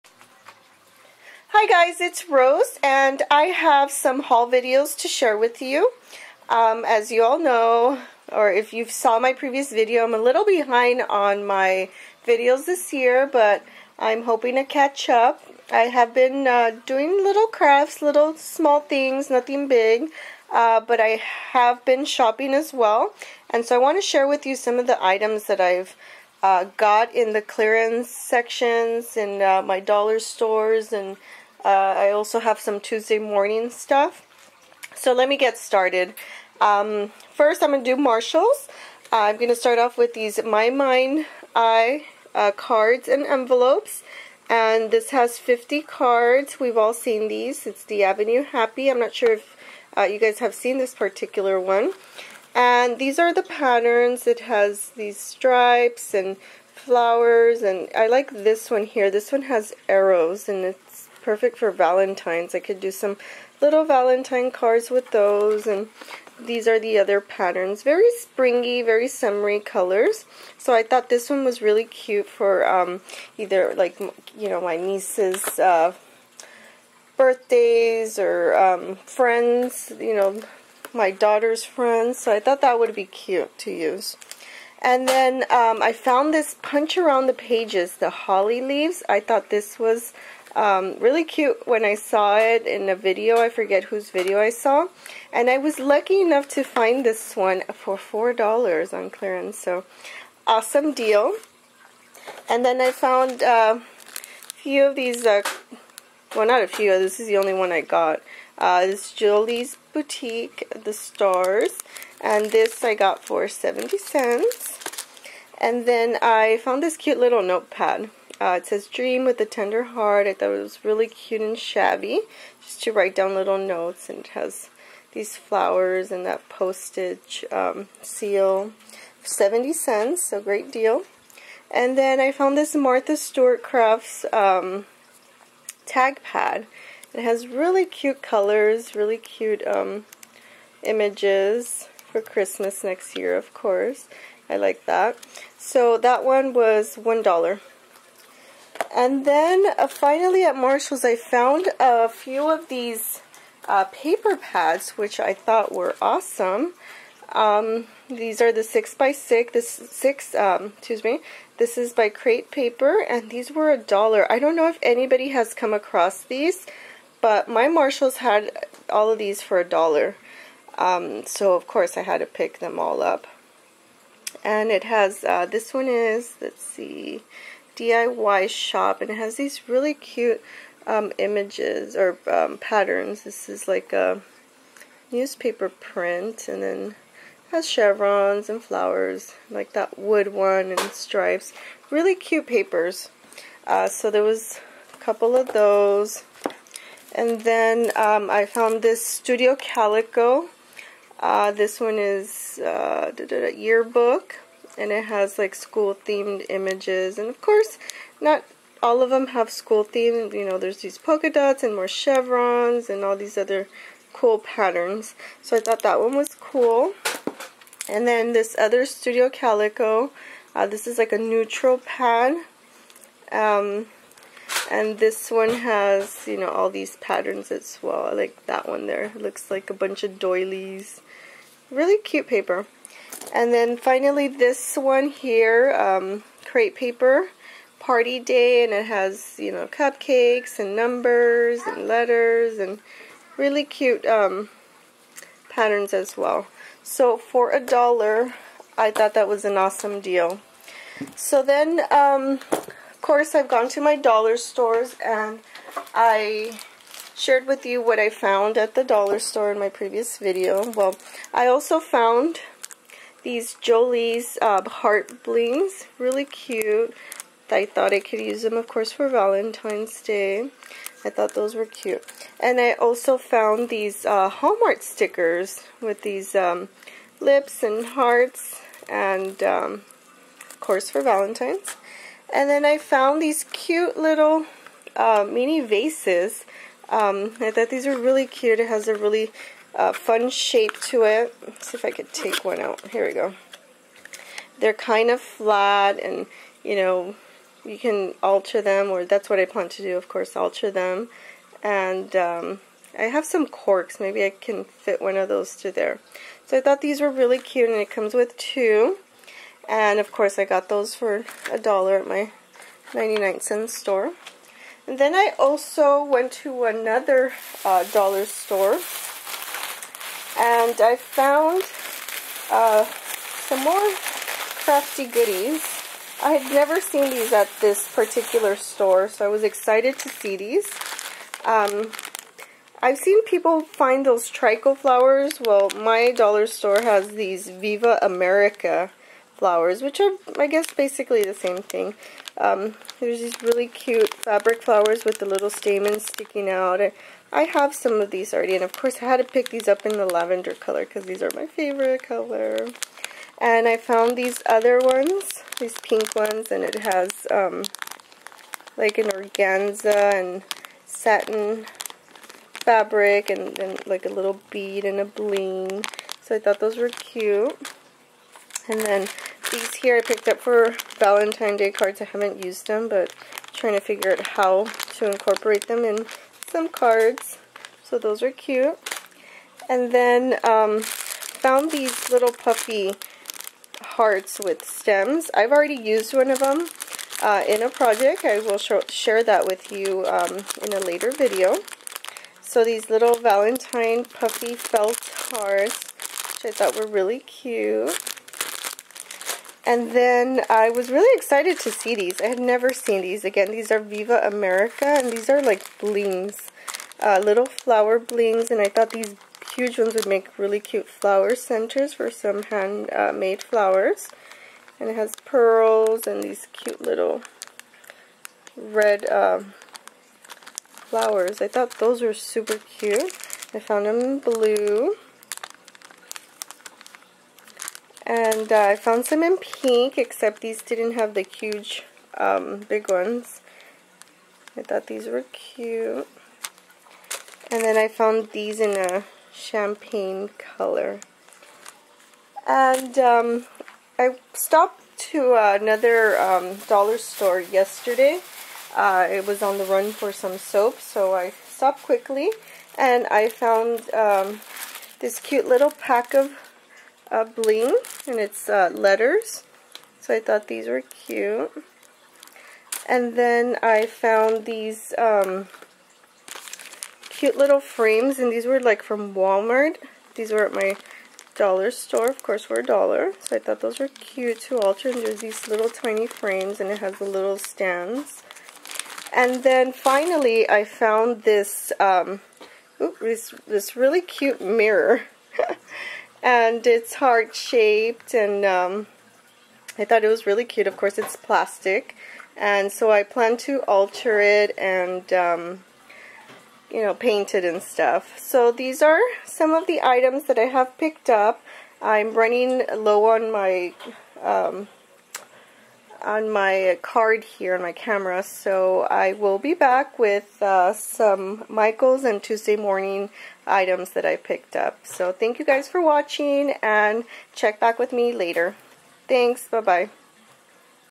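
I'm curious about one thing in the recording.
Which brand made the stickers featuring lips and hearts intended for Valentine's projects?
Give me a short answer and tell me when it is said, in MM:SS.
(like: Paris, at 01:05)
Hallmark, at 04:34.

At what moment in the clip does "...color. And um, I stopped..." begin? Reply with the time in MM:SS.
07:20.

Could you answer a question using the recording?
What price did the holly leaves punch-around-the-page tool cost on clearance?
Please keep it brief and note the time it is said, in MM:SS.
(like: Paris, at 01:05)
$4, at 01:37.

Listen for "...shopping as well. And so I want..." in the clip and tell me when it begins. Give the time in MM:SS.
00:22.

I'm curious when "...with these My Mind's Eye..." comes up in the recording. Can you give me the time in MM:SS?
00:39.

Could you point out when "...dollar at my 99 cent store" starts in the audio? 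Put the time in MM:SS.
05:11.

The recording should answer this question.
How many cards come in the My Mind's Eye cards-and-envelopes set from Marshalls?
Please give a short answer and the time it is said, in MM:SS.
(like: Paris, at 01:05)
50, at 00:45.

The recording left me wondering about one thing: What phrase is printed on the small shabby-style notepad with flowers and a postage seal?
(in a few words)
Dream with a Tender Heart.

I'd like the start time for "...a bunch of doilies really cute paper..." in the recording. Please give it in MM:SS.
03:49.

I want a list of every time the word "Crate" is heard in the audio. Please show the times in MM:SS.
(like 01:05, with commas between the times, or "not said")
02:42, 03:56.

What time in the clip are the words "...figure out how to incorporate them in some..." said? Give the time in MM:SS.
06:13.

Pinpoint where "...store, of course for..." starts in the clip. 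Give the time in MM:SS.
07:51.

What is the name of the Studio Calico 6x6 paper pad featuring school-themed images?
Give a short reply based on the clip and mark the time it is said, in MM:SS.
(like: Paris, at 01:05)
yearbook, at 03:23.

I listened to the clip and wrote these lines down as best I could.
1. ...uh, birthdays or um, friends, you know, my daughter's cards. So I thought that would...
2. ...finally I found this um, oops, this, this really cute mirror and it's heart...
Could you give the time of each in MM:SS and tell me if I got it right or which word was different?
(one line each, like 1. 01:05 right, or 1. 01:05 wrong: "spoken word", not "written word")
1. 01:15 wrong: "friends", not "cards"
2. 07:59 right.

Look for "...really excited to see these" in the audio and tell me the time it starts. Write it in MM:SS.
06:40.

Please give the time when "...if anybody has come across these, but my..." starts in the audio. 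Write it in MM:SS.
02:44.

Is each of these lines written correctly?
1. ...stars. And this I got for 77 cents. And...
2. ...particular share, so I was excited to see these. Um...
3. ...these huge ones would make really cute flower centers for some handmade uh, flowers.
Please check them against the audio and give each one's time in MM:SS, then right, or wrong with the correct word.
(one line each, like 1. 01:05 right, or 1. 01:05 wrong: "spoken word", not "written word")
1. 01:50 wrong: "70", not "77"
2. 05:27 wrong: "store", not "share"
3. 06:48 right.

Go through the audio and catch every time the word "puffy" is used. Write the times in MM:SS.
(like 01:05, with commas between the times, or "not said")
06:22, 06:34.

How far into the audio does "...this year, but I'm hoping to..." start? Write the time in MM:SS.
00:12.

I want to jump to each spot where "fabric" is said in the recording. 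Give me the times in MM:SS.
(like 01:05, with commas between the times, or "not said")
05:44, 06:02.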